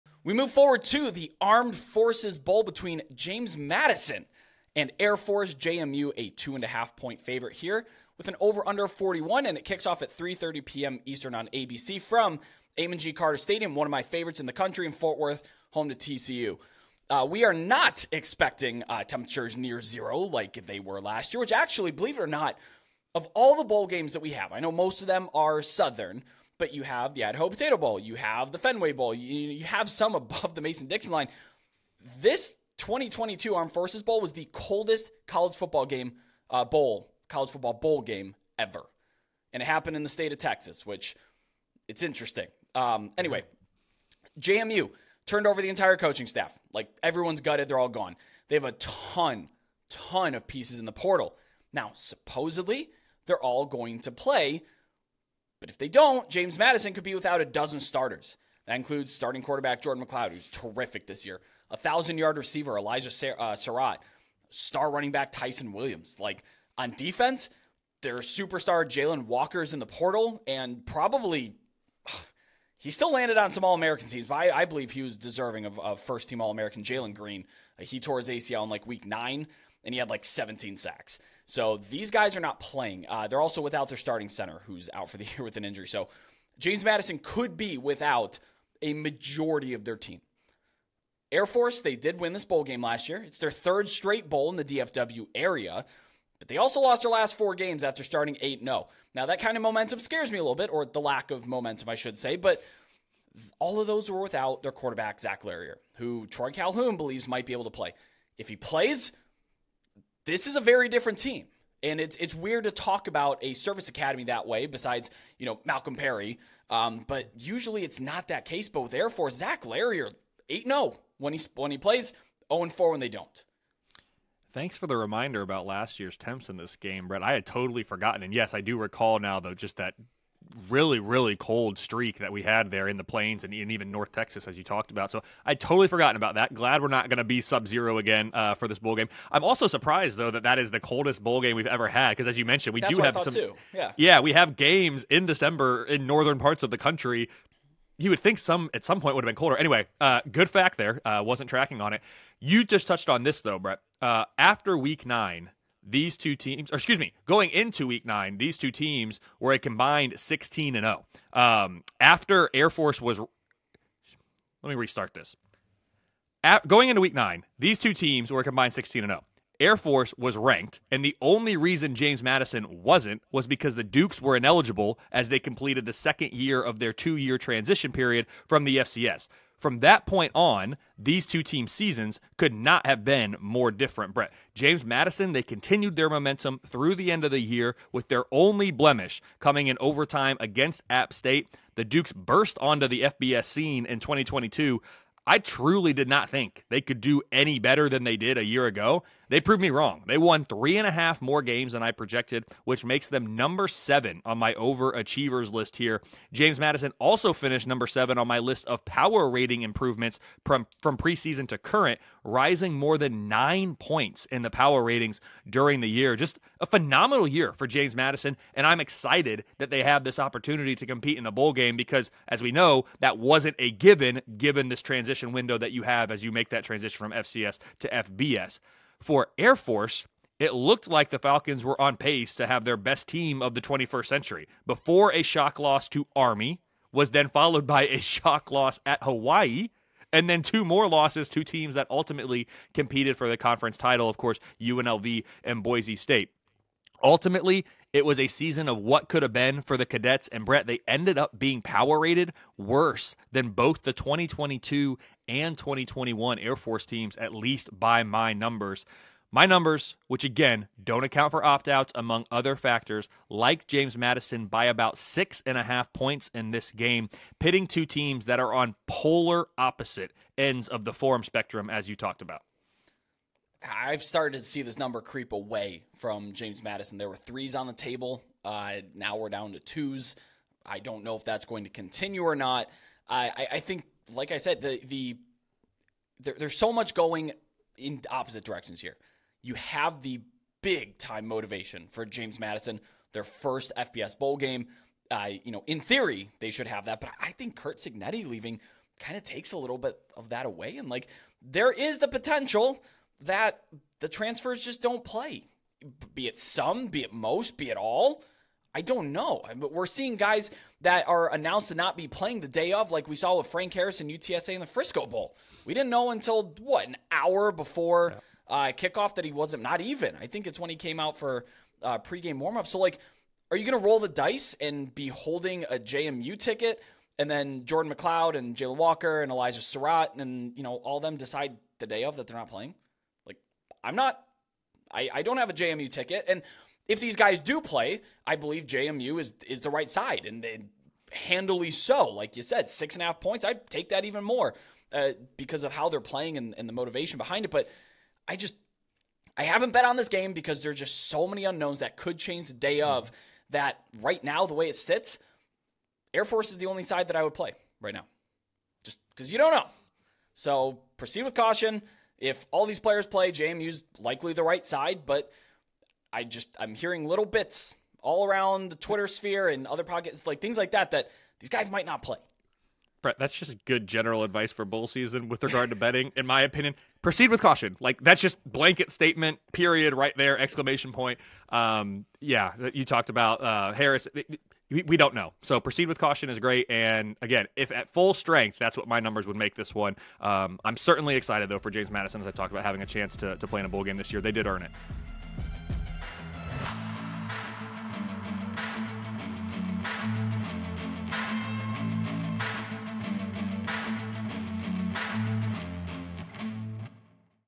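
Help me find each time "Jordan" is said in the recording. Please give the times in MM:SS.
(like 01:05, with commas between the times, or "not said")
00:59, 05:27.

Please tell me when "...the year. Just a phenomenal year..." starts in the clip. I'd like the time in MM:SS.
03:35.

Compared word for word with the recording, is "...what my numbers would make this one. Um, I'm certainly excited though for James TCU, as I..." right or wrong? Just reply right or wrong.
wrong.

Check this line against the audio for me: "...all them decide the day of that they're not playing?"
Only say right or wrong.
right.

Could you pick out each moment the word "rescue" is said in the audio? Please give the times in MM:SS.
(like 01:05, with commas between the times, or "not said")
not said.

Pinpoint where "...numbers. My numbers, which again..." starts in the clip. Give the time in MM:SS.
04:18.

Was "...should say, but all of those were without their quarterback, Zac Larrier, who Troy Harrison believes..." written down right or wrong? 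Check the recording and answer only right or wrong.
wrong.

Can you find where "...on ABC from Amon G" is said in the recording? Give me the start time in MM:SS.
00:11.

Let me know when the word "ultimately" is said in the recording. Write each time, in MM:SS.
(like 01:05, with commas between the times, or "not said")
04:01, 04:07.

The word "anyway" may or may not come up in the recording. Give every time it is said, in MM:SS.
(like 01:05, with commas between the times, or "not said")
00:43, 02:29.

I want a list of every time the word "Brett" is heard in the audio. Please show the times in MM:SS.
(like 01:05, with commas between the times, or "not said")
02:07, 02:33, 03:04, 04:10, 06:13.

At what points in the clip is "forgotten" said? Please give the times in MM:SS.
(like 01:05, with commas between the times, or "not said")
02:07, 02:15.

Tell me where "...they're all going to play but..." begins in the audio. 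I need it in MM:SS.
00:53.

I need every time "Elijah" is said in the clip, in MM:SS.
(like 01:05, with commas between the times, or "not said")
01:02, 05:29.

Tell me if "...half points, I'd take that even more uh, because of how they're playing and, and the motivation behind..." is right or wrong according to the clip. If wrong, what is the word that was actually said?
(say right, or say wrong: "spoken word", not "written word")
right.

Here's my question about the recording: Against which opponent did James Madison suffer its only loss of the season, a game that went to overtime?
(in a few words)
App State.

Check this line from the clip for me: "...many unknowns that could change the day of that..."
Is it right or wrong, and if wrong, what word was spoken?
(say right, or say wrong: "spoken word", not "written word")
right.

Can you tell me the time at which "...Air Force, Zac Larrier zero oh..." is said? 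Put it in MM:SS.
01:58.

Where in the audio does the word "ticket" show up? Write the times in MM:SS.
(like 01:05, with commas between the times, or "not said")
05:26, 05:35.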